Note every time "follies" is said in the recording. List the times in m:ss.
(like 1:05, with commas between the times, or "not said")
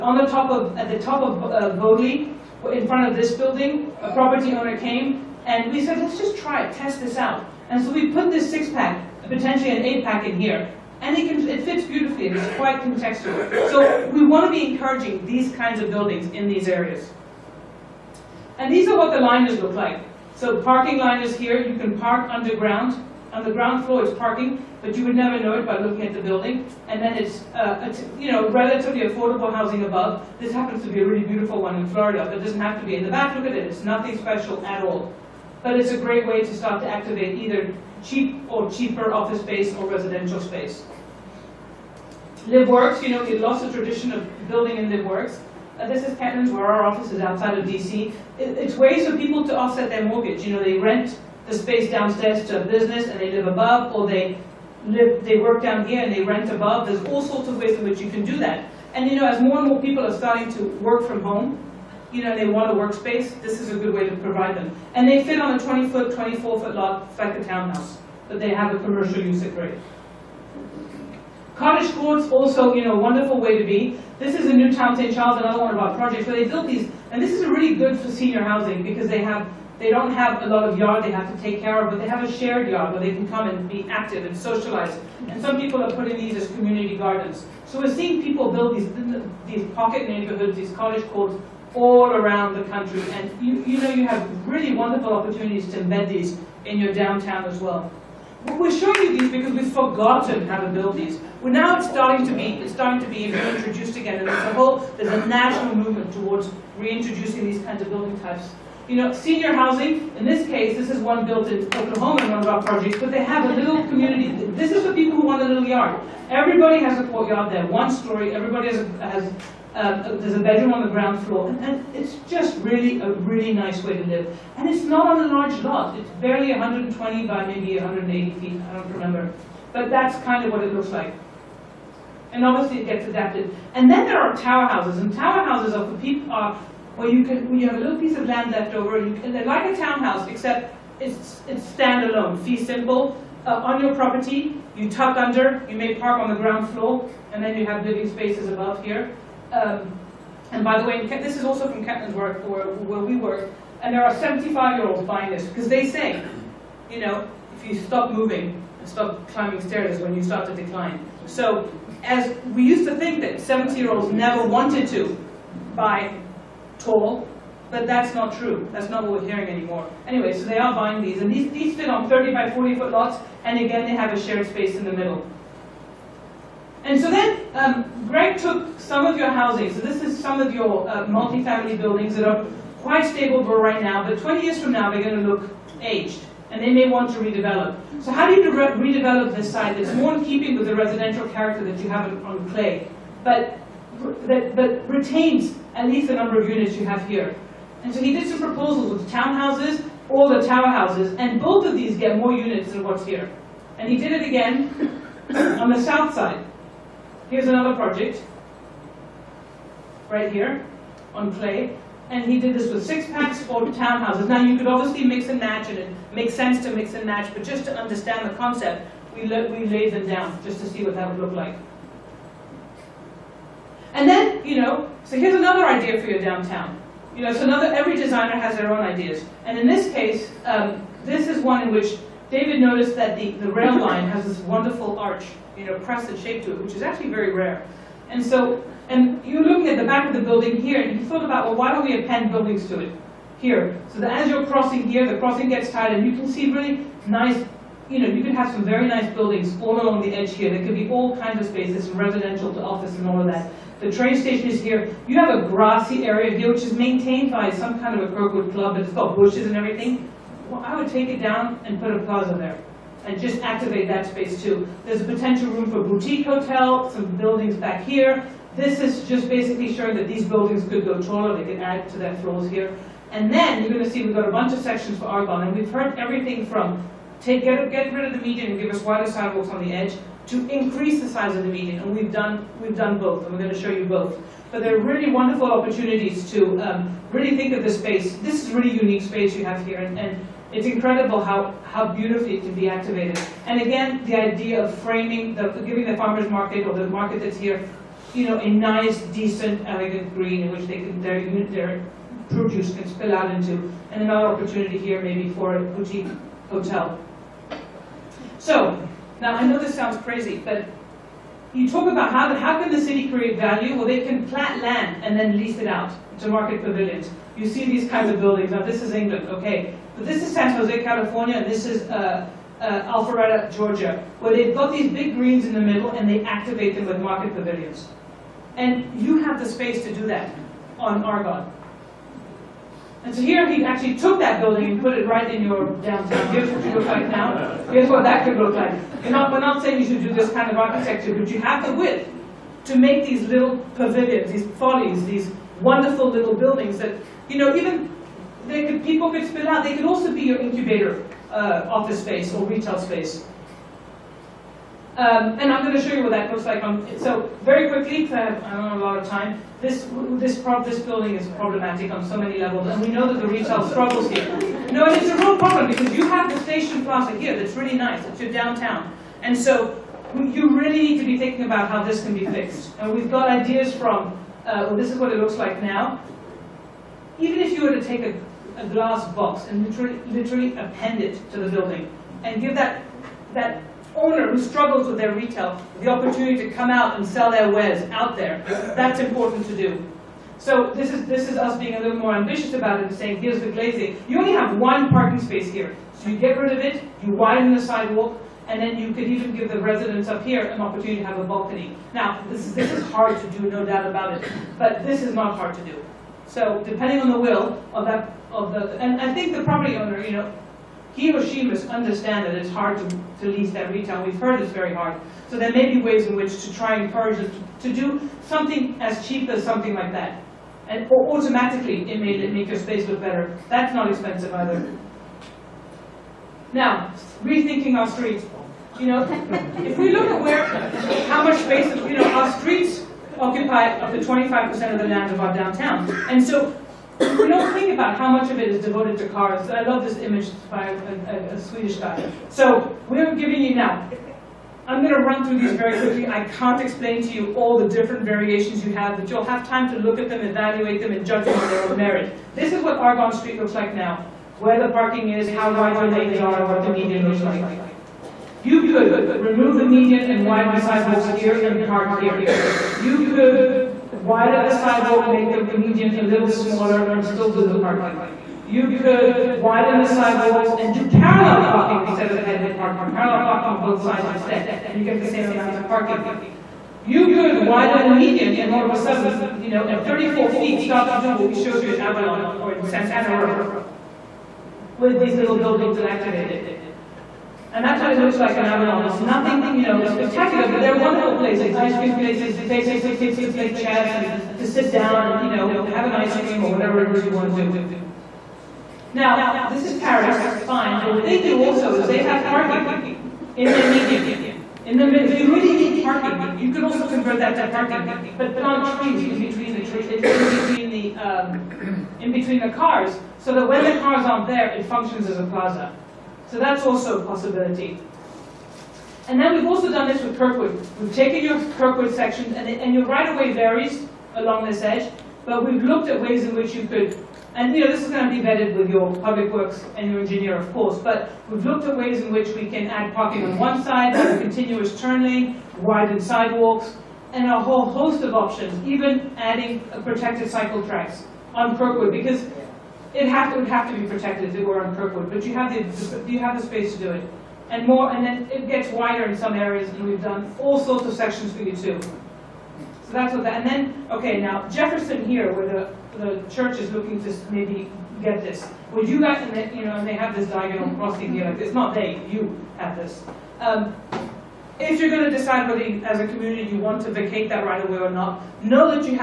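5:44.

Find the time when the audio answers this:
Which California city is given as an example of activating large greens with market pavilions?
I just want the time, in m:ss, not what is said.
5:20.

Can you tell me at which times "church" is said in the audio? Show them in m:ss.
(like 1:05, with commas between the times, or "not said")
9:16.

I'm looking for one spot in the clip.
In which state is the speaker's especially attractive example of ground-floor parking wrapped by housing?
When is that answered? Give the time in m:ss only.
0:31.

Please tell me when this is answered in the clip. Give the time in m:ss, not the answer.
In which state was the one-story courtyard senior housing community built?
1:51.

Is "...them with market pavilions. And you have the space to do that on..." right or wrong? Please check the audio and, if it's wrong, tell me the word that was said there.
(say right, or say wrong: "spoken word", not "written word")
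right.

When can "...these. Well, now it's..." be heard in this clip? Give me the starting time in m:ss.
1:40.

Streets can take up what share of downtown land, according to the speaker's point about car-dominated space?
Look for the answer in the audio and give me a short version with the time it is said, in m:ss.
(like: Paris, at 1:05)
25%, at 7:13.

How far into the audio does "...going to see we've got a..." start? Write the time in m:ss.
4:33.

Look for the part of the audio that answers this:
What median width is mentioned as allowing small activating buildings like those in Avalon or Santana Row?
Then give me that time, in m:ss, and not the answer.
7:59.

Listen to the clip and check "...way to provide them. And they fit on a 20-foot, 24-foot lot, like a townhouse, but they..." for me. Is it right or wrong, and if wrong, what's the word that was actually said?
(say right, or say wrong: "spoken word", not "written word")
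right.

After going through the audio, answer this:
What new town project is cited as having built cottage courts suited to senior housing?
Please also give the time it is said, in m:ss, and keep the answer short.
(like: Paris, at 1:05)
St. Charles, at 1:14.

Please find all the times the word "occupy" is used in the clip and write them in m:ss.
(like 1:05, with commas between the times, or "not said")
7:13.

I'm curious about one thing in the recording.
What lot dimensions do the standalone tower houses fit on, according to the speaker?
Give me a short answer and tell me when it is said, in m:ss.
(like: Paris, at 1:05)
30 by 40 feet, at 2:52.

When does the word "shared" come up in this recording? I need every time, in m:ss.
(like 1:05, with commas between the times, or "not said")
1:22, 2:54.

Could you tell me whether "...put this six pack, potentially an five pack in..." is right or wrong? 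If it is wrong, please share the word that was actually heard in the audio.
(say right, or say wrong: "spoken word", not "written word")
wrong: "eight", not "five".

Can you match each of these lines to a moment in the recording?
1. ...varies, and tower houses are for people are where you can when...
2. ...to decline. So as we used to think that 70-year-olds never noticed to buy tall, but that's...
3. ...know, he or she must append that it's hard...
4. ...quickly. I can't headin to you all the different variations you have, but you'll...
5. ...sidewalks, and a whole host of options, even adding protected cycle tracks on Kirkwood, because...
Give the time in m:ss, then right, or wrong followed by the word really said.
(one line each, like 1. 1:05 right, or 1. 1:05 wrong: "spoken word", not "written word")
1. 2:14 wrong: "houses", not "varies"
2. 2:40 wrong: "wanted", not "noticed"
3. 6:50 wrong: "understand", not "append"
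4. 7:25 wrong: "explain", not "headin"
5. 8:56 right.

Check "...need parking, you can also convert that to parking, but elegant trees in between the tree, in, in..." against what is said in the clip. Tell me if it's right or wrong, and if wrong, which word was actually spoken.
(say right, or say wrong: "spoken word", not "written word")
wrong: "plant", not "elegant".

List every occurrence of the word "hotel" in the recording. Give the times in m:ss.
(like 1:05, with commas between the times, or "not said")
4:26, 5:06.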